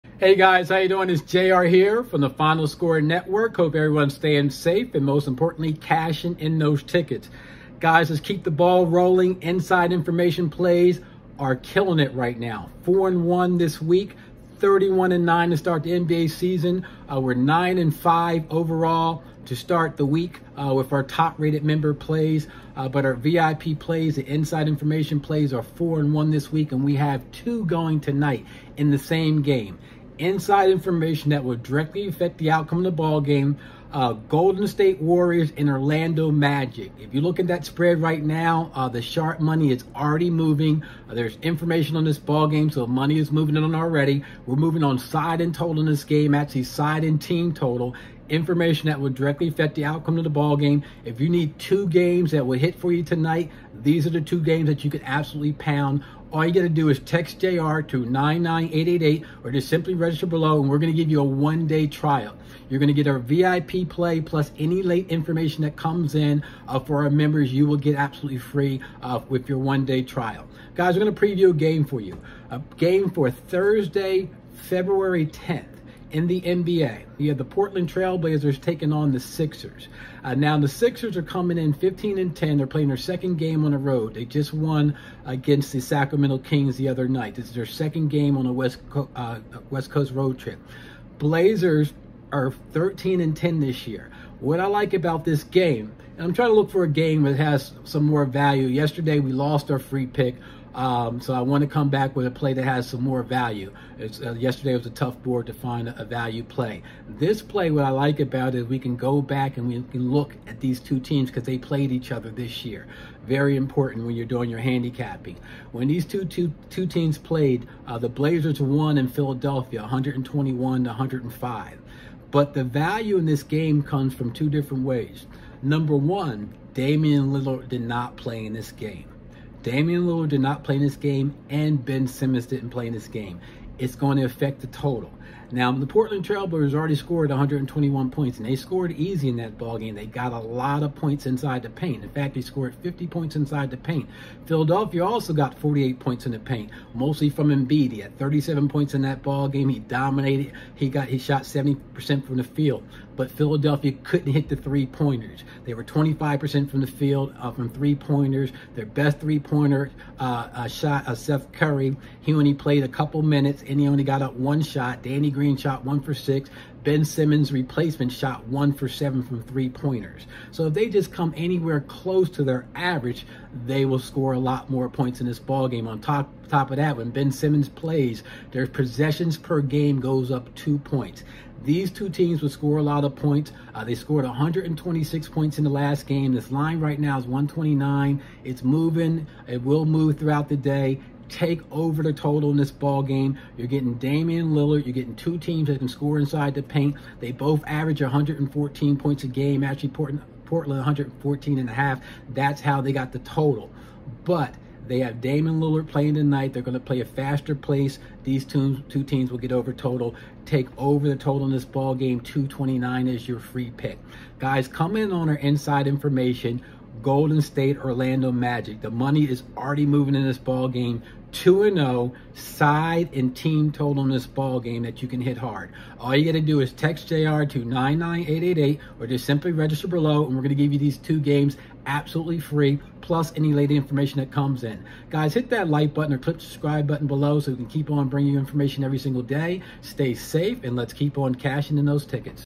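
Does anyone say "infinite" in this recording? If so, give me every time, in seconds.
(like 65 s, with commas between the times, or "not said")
not said.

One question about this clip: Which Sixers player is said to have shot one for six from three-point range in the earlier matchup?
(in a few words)
Danny Green.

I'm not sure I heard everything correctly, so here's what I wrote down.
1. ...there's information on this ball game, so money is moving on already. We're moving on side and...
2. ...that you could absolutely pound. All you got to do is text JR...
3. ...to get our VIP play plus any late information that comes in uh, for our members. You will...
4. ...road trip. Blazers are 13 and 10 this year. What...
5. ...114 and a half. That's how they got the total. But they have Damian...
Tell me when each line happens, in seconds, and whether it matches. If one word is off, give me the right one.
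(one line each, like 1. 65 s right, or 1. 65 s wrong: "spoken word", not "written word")
1. 41 s right
2. 54 s right
3. 62 s right
4. 90 s right
5. 200 s right.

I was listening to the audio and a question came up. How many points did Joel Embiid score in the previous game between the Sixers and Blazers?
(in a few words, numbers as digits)
37.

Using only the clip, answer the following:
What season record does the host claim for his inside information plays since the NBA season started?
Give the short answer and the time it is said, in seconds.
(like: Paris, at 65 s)
31-9, at 14 s.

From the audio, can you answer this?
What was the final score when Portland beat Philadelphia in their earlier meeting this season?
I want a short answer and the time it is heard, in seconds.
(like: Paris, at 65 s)
121-105, at 119 s.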